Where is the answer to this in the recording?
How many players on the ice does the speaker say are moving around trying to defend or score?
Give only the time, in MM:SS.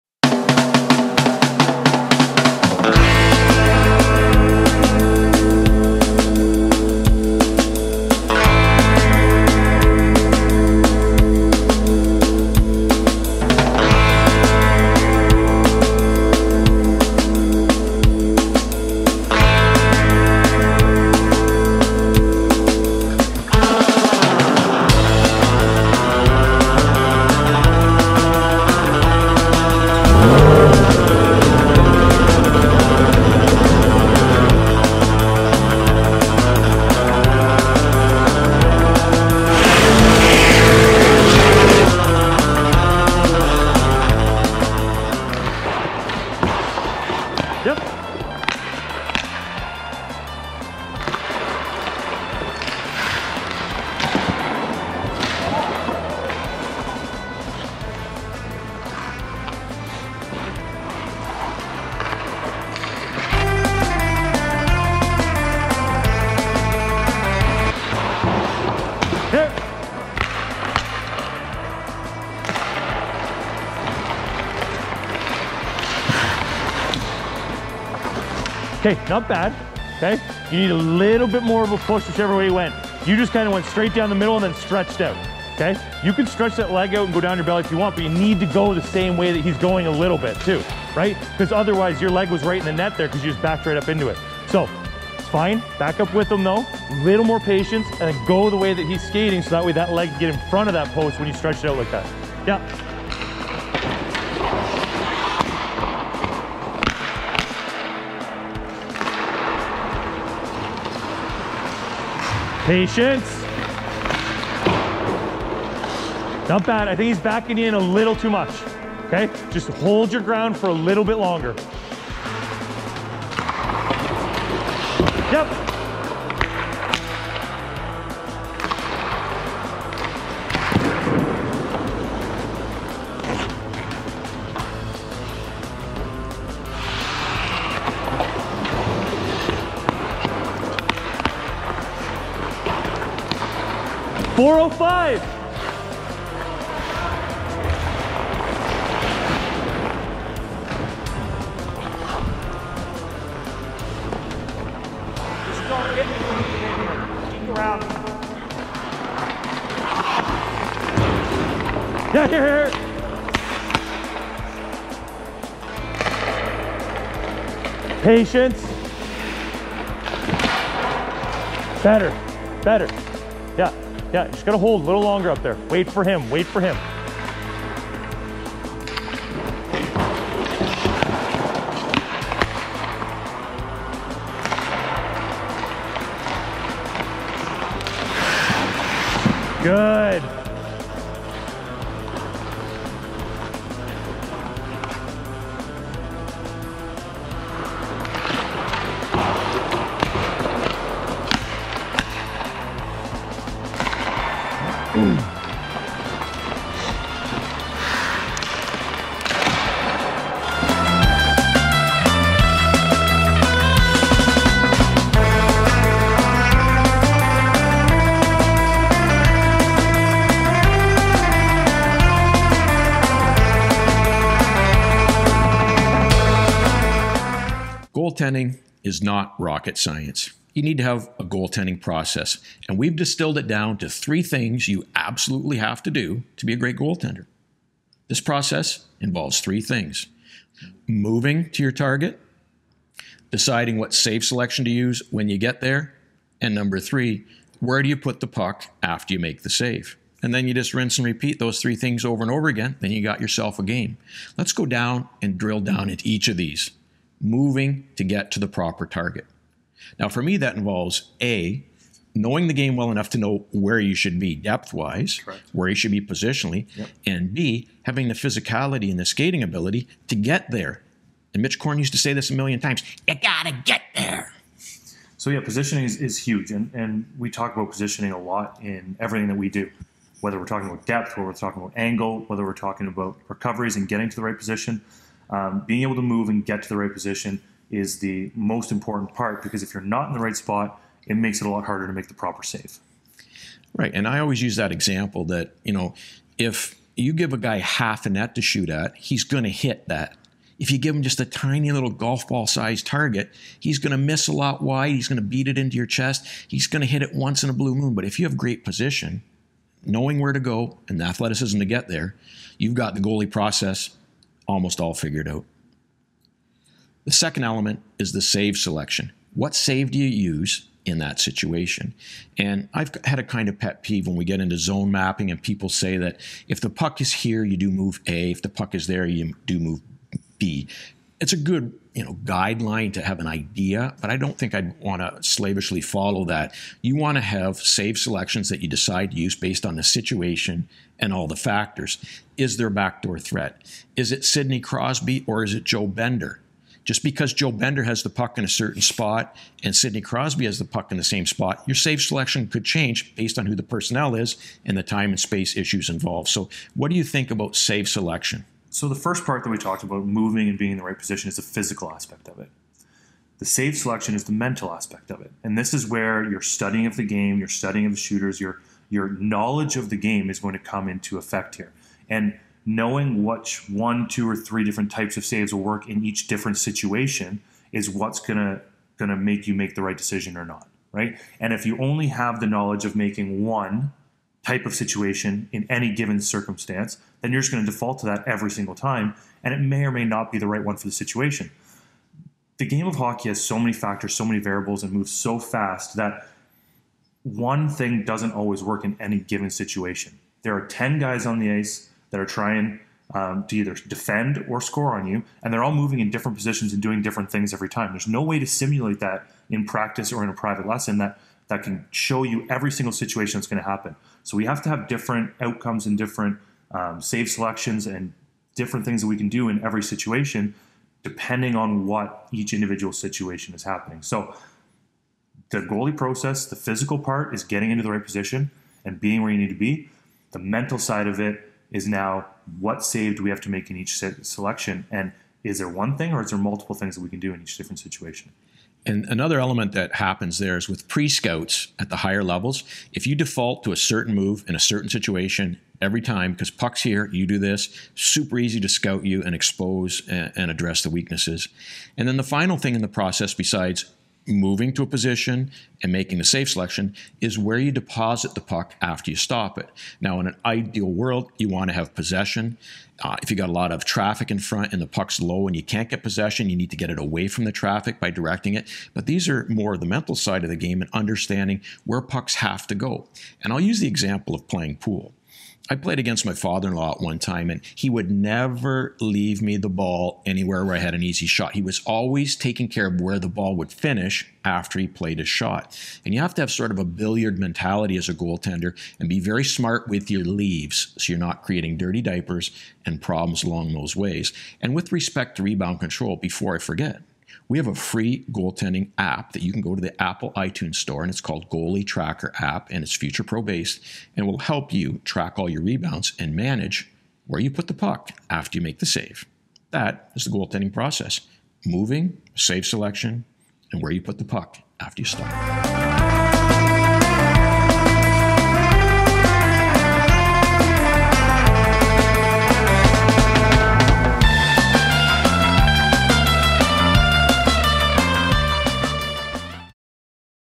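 06:40.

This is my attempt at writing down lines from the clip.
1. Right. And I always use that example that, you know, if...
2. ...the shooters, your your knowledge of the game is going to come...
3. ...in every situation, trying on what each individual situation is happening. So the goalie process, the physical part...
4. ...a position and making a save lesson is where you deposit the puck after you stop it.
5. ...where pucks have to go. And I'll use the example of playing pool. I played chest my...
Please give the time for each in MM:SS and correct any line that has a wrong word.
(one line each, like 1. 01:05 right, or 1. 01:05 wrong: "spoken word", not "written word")
1. 04:53 right
2. 06:07 right
3. 06:59 wrong: "depending", not "trying"
4. 07:34 wrong: "selection", not "lesson"
5. 07:51 wrong: "against", not "chest".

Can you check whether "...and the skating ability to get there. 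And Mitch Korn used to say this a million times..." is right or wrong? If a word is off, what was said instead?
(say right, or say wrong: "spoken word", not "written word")
right.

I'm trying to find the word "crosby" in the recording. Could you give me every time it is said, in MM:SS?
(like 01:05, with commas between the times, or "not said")
05:44, 05:50.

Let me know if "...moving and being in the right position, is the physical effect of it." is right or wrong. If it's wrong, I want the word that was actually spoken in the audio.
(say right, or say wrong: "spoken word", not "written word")
wrong: "aspect", not "effect".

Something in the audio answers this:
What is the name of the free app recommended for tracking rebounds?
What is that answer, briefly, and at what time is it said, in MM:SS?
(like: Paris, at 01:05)
Goalie Tracker App, at 08:21.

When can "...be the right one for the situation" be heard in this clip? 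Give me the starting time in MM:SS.
06:30.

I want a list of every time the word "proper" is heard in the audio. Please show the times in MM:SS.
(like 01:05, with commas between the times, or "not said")
04:18, 04:52.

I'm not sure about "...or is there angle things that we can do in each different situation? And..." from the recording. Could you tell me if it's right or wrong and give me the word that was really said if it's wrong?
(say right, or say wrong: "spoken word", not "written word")
wrong: "multiple", not "angle".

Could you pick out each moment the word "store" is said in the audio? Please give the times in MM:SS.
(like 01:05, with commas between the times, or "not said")
08:20.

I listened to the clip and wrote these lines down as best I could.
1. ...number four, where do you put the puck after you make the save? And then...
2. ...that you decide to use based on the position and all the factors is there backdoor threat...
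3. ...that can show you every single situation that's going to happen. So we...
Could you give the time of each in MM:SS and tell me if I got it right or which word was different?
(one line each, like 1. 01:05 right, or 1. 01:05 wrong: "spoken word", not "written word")
1. 04:06 wrong: "three", not "four"
2. 05:38 wrong: "situation", not "position"
3. 06:51 right.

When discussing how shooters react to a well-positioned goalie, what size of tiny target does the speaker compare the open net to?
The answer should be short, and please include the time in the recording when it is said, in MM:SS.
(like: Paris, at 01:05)
golf ball sized, at 05:01.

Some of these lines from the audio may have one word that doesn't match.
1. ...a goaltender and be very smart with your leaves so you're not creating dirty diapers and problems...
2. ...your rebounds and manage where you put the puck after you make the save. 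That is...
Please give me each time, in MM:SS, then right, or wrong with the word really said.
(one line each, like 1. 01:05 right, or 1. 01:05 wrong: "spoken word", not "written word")
1. 08:08 right
2. 08:25 right.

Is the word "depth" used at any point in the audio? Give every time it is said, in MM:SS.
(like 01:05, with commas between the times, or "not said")
04:24, 04:40.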